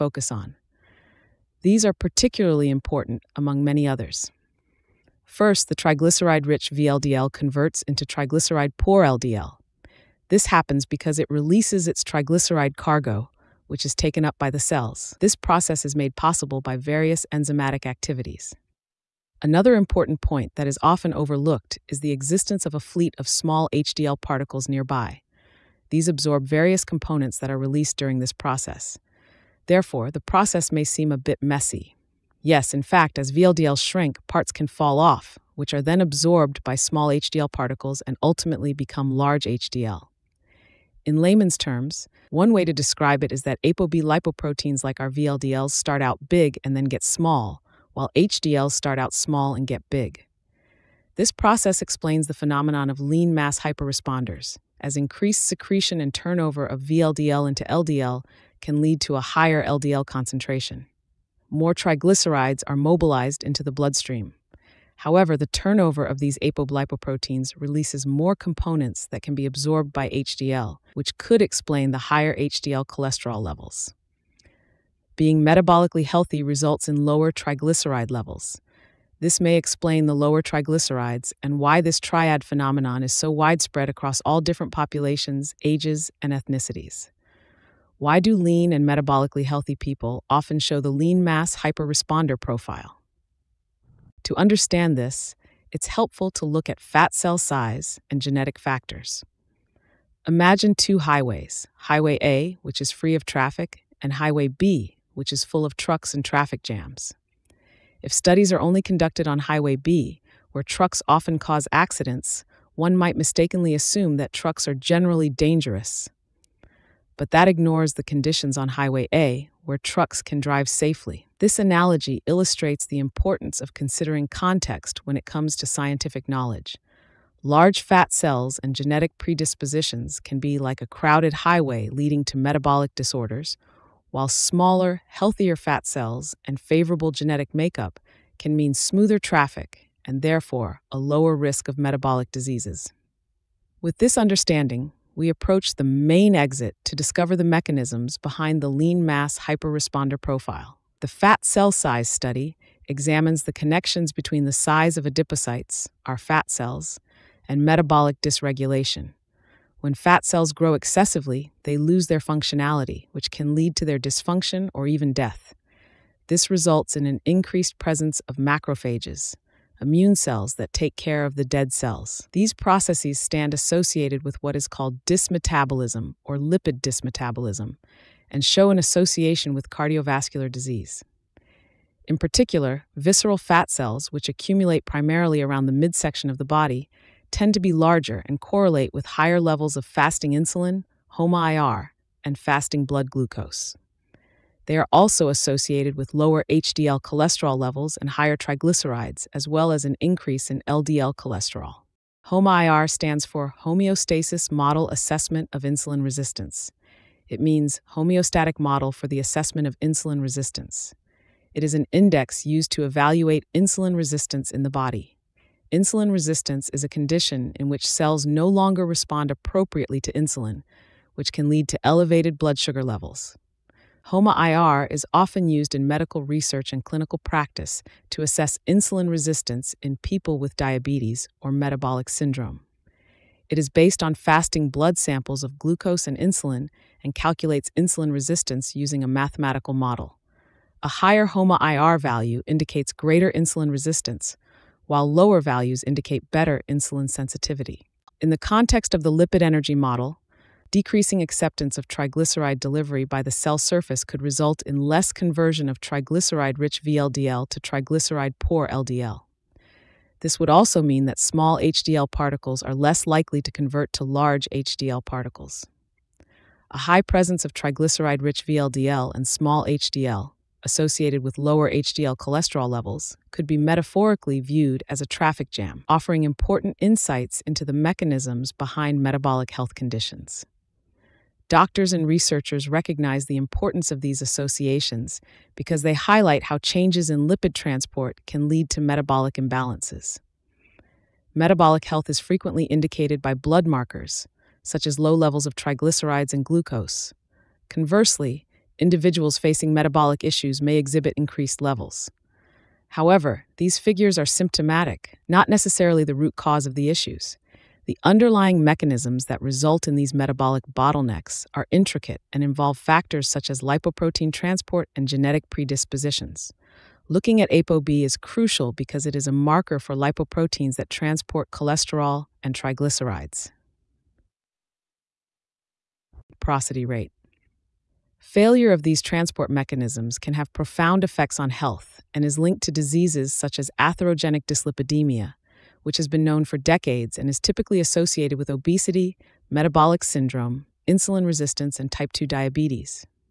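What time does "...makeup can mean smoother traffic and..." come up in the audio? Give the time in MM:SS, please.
02:17.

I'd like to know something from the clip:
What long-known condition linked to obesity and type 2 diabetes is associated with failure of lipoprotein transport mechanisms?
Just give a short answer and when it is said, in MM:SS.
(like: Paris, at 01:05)
Atherogenic dyslipidemia, at 05:33.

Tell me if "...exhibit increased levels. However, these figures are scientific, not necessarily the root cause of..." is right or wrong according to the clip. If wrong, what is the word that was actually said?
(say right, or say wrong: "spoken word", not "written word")
wrong: "symptomatic", not "scientific".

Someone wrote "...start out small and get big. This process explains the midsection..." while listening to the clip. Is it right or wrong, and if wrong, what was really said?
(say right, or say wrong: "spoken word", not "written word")
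wrong: "phenomenon", not "midsection".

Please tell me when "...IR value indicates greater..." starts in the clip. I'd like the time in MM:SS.
04:01.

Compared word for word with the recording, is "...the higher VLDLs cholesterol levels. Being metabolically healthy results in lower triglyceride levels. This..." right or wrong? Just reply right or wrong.
wrong.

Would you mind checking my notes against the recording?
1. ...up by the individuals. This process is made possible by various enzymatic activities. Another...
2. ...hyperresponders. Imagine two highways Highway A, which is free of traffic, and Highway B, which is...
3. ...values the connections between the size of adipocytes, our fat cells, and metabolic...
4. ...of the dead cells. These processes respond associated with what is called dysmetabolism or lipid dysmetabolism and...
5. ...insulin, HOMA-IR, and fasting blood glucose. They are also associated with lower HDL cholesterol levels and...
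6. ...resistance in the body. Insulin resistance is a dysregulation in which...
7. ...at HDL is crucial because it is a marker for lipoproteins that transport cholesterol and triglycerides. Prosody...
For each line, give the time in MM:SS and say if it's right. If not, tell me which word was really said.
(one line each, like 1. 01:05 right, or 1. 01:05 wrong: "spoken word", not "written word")
1. 00:14 wrong: "cells", not "individuals"
2. 01:38 wrong: "factors", not "hyperresponders"
3. 02:32 wrong: "examines", not "values"
4. 02:51 wrong: "stand", not "respond"
5. 03:10 right
6. 03:33 wrong: "condition", not "dysregulation"
7. 05:17 wrong: "ApoB", not "HDL".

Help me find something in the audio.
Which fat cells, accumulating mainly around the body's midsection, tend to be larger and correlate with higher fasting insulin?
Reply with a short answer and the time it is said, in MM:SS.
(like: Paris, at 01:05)
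Visceral fat cells, at 03:02.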